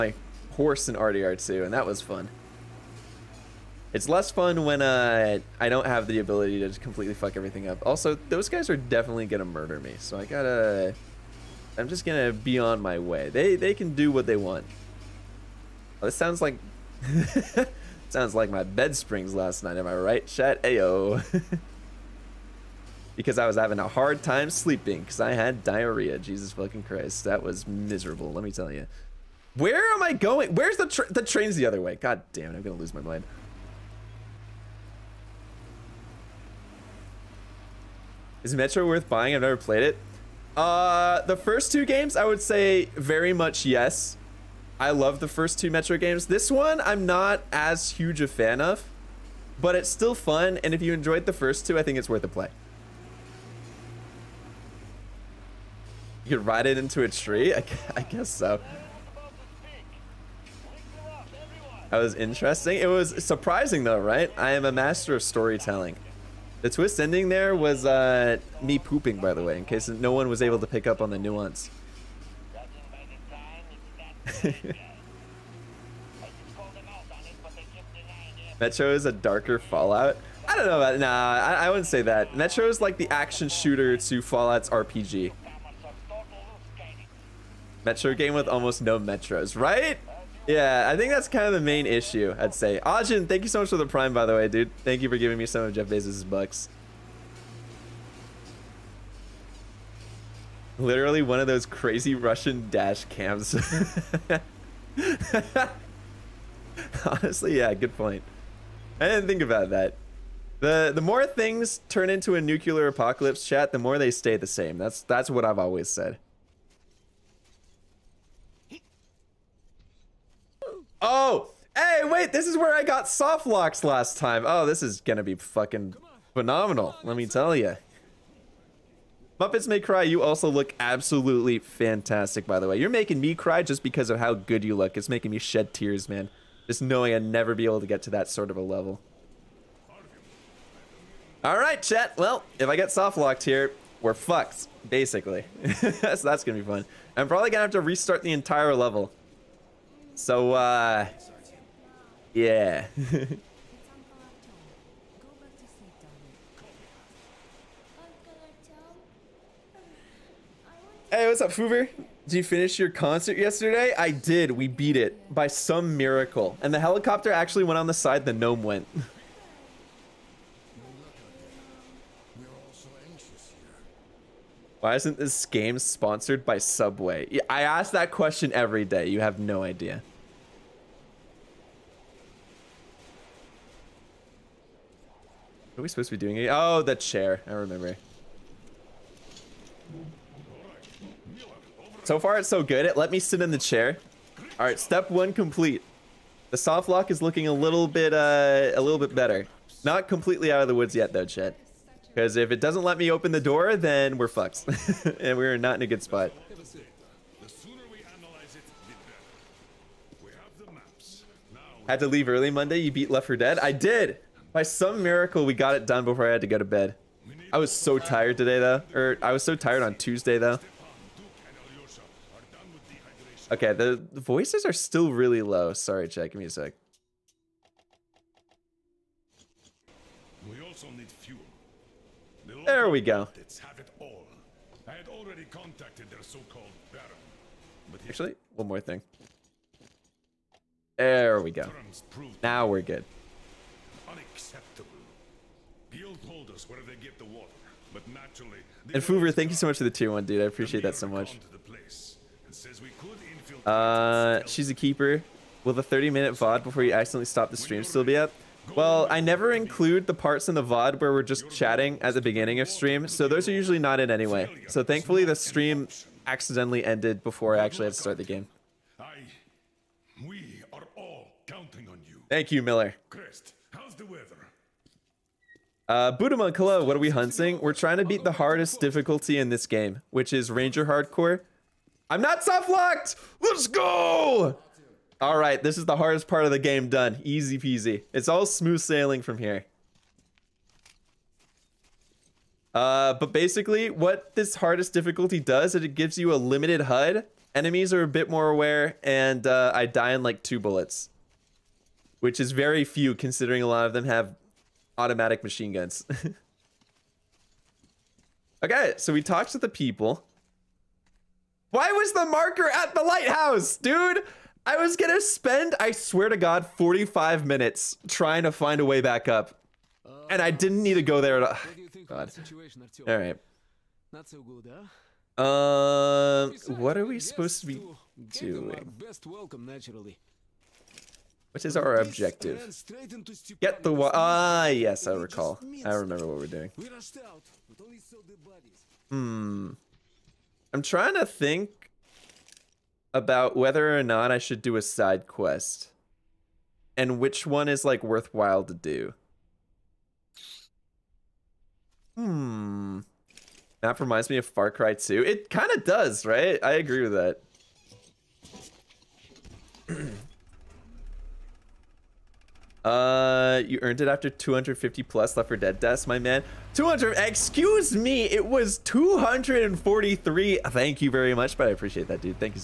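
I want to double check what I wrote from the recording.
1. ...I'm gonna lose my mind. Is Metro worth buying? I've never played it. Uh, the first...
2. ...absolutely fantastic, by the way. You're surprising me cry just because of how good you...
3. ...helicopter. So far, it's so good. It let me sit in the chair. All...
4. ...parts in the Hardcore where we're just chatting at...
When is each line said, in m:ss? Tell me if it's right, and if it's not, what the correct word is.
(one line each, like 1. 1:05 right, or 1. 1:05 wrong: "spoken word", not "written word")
1. 0:32 right
2. 2:10 wrong: "making", not "surprising"
3. 3:07 wrong: "remember", not "helicopter"
4. 4:20 wrong: "VOD", not "Hardcore".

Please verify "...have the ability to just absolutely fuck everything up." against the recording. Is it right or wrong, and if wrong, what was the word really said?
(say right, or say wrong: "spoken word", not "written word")
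wrong: "completely", not "absolutely".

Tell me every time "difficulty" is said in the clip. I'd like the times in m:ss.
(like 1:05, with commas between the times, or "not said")
4:38, 4:54.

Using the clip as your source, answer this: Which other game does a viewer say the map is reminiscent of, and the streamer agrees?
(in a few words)
Far Cry 2.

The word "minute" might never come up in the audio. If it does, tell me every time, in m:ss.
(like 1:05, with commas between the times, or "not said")
4:16, 5:17.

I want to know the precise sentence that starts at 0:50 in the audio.
And if you enjoyed the first two, I think it's worth a play.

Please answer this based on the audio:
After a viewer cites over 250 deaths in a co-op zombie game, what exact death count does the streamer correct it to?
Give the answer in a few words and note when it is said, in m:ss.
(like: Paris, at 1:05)
243, at 6:08.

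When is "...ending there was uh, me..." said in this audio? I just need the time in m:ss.
1:06.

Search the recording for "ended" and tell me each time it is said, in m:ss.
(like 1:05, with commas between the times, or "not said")
4:26.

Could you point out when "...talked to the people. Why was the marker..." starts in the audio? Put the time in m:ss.
5:09.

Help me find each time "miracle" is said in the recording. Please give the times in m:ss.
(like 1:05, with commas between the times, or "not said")
2:45, 3:35.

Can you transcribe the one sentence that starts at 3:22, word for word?
Because if it doesn't let me open the door, then we're fucked.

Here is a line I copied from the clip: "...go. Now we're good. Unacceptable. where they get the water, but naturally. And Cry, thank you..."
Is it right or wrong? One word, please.
wrong.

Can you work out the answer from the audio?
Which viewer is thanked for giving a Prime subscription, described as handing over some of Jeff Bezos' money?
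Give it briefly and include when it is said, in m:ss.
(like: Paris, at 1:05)
Ajin, at 1:32.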